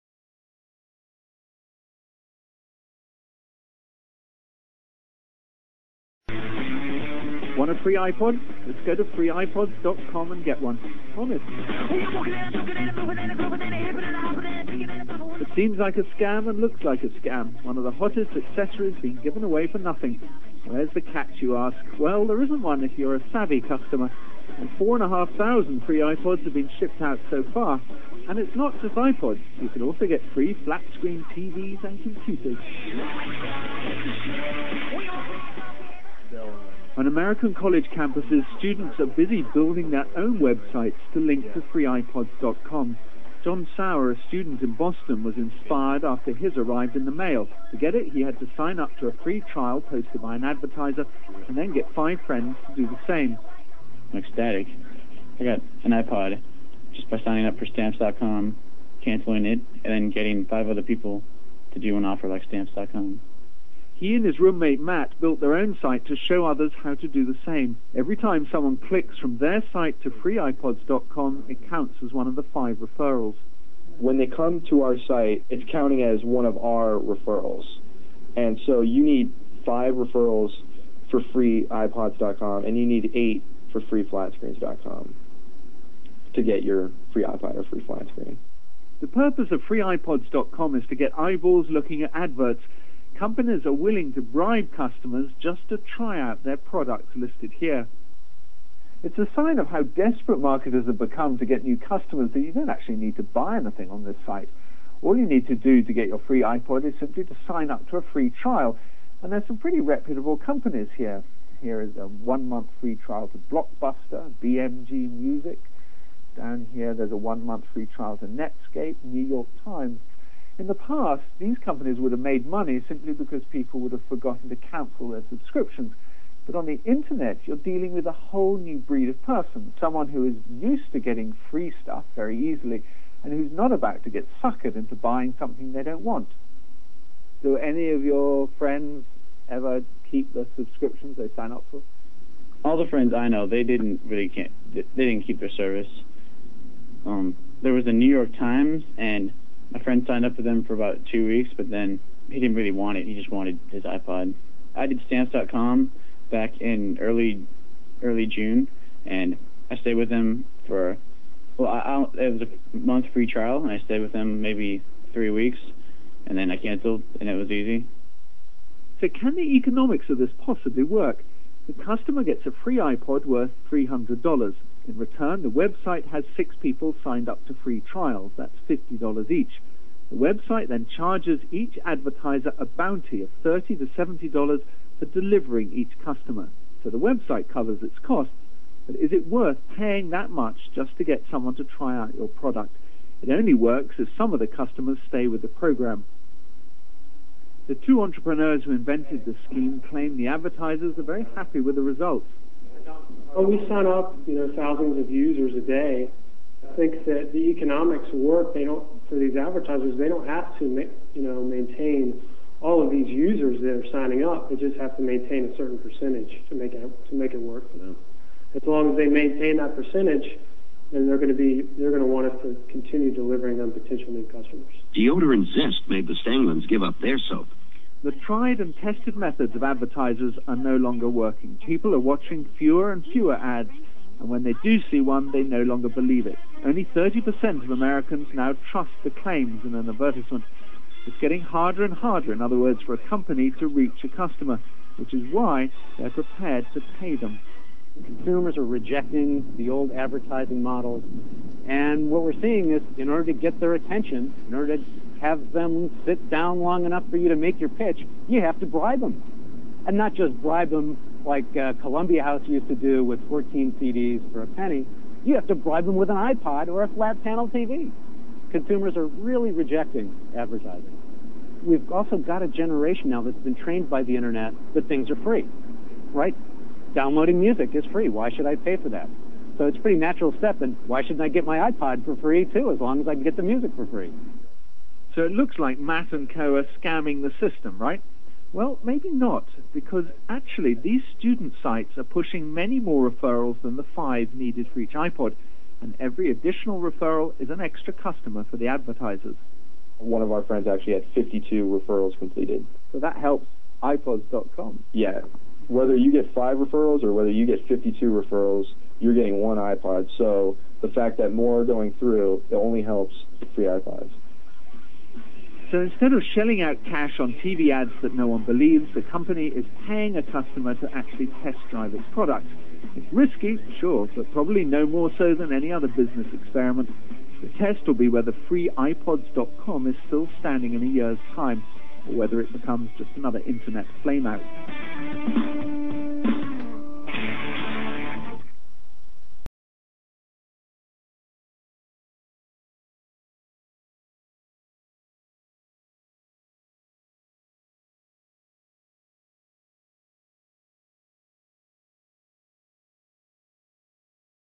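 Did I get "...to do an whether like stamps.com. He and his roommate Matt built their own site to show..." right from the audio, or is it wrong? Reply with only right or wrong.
wrong.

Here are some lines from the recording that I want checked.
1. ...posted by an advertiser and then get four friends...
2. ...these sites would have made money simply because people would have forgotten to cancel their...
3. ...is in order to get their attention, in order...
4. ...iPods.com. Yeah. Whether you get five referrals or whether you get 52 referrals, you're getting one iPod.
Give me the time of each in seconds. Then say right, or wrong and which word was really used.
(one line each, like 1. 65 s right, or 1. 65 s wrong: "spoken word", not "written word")
1. 49 s wrong: "five", not "four"
2. 121 s wrong: "companies", not "sites"
3. 252 s right
4. 303 s right.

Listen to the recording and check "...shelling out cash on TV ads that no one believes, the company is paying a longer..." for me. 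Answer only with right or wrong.
wrong.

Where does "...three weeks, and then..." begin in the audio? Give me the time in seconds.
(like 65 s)
165 s.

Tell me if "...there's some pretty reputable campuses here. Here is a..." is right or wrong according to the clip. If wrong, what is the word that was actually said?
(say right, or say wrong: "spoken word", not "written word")
wrong: "companies", not "campuses".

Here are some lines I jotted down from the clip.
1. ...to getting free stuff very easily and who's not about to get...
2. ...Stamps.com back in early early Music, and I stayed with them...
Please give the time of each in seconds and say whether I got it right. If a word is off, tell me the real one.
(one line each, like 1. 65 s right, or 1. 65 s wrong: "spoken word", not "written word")
1. 130 s right
2. 155 s wrong: "June", not "Music".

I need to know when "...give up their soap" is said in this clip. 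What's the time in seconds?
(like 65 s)
226 s.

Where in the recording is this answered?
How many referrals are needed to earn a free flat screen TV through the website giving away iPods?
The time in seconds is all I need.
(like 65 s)
83 s.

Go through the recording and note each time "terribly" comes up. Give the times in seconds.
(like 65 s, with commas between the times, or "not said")
not said.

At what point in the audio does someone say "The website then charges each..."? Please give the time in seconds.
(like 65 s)
180 s.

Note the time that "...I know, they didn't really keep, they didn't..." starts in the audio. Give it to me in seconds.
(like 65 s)
143 s.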